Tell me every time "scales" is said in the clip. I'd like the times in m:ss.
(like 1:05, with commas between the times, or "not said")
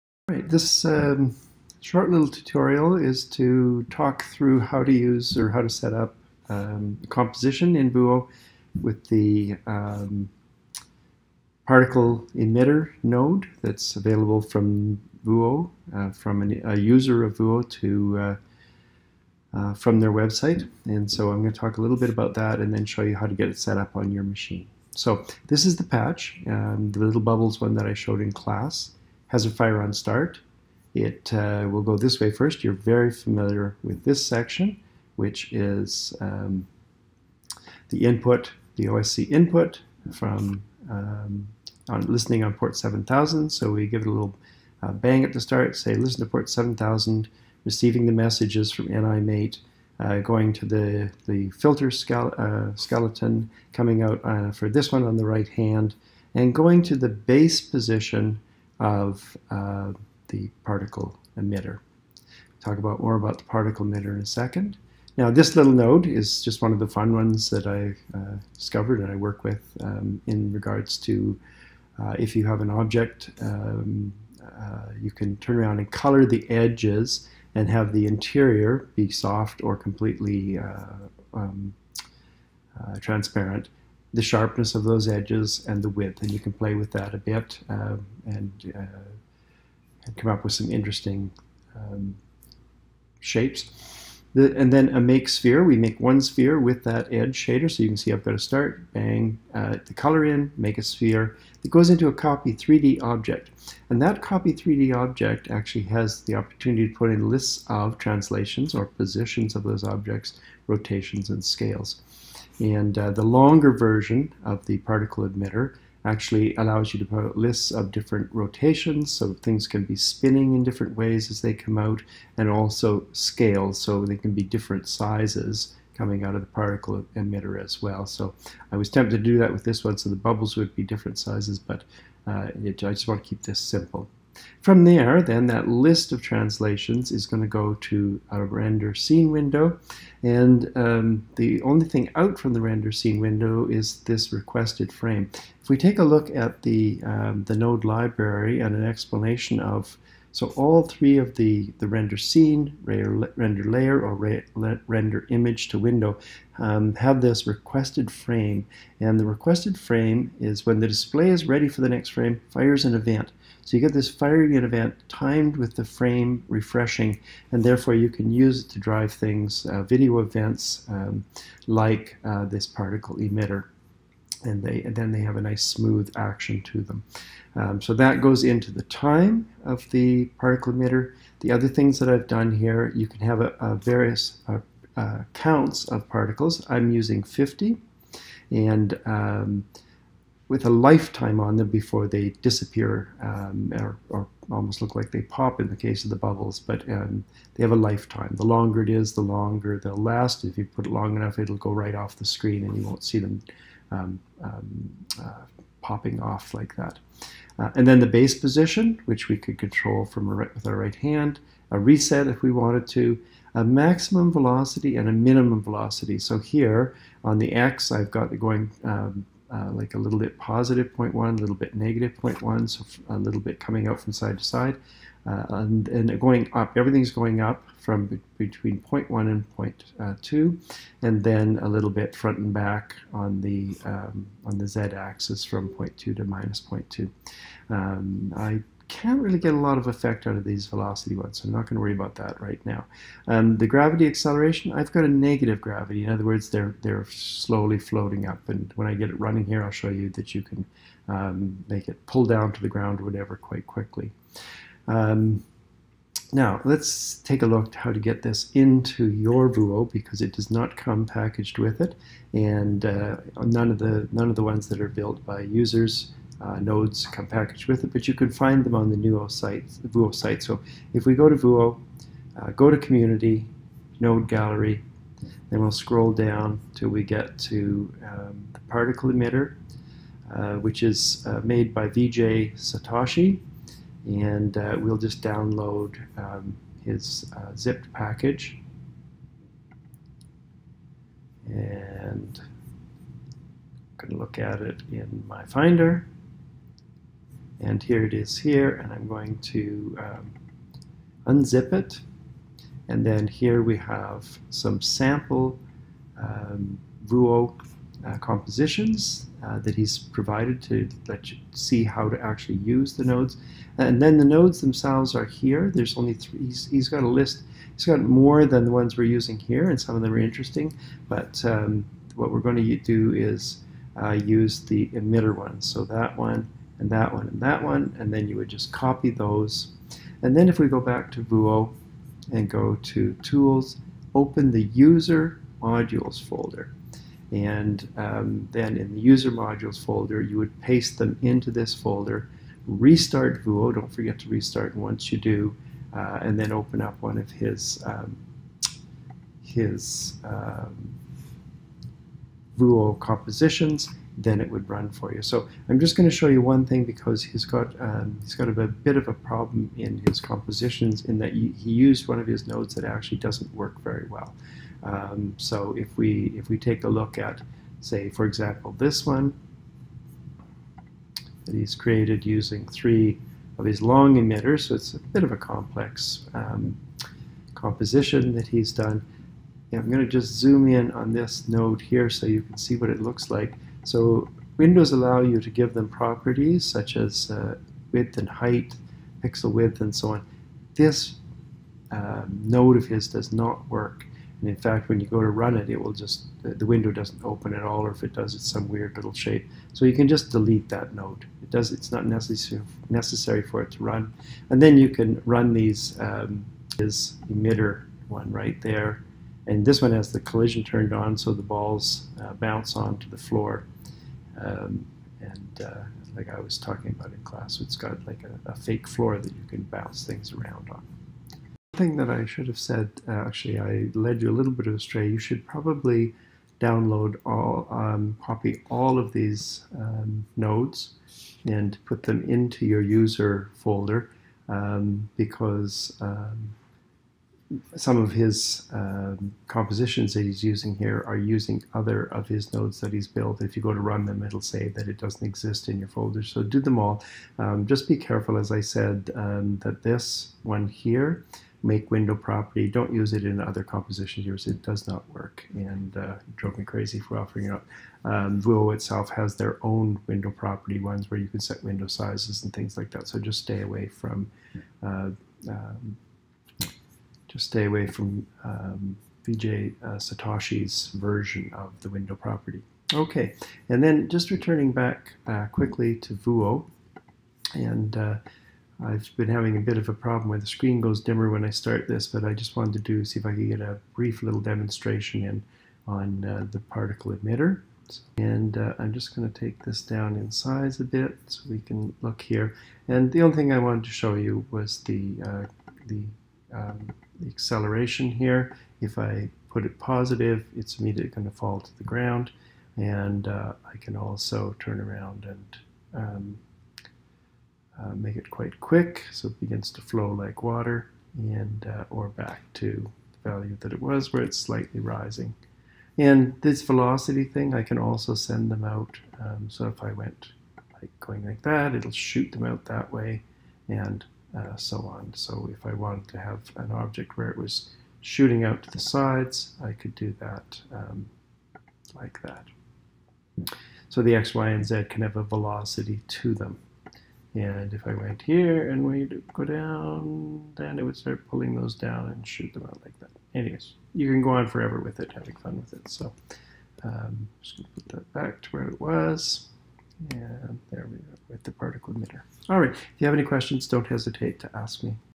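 1:51, 2:03.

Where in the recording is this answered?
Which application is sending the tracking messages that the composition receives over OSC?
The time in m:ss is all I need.
0:48.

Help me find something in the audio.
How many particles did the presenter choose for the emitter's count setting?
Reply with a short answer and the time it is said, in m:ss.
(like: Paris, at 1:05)
50, at 3:07.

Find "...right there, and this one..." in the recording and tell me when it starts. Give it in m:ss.
6:48.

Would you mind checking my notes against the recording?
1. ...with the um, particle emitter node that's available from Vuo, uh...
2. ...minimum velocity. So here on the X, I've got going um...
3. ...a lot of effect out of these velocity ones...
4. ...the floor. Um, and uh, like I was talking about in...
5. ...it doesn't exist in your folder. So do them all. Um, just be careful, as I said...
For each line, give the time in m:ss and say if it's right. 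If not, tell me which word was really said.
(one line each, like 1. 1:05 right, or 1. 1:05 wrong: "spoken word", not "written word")
1. 0:08 right
2. 3:35 right
3. 3:59 right
4. 6:53 right
5. 7:24 right.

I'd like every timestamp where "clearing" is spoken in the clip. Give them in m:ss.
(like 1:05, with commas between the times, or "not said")
not said.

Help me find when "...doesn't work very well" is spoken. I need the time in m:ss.
6:03.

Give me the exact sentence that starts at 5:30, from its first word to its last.
And then if we go back to Vuo and go to Tools, open the User Modules folder.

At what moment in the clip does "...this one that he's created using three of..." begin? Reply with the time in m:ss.
6:08.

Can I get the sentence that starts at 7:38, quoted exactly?
Um, Vuo itself has their own window property ones where you can set window sizes and things like that.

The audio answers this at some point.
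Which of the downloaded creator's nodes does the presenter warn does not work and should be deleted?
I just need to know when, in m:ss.
7:31.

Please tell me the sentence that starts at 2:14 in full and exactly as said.
From there, then, that list of translations is going to go to a render scene window.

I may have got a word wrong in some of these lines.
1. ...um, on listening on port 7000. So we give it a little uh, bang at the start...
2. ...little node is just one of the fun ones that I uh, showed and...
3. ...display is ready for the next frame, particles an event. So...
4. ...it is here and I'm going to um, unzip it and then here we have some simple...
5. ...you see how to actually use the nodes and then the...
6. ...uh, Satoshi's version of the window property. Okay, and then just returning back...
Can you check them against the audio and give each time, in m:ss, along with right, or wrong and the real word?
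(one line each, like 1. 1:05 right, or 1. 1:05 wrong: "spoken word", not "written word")
1. 0:40 right
2. 1:05 wrong: "discovered", not "showed"
3. 2:40 wrong: "fires", not "particles"
4. 4:58 wrong: "sample", not "simple"
5. 5:11 right
6. 7:49 right.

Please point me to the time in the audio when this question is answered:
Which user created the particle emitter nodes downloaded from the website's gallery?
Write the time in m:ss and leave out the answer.
4:41.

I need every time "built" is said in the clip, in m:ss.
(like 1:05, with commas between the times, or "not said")
4:24, 7:23.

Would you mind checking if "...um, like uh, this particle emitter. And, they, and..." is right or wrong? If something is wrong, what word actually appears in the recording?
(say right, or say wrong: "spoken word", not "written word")
right.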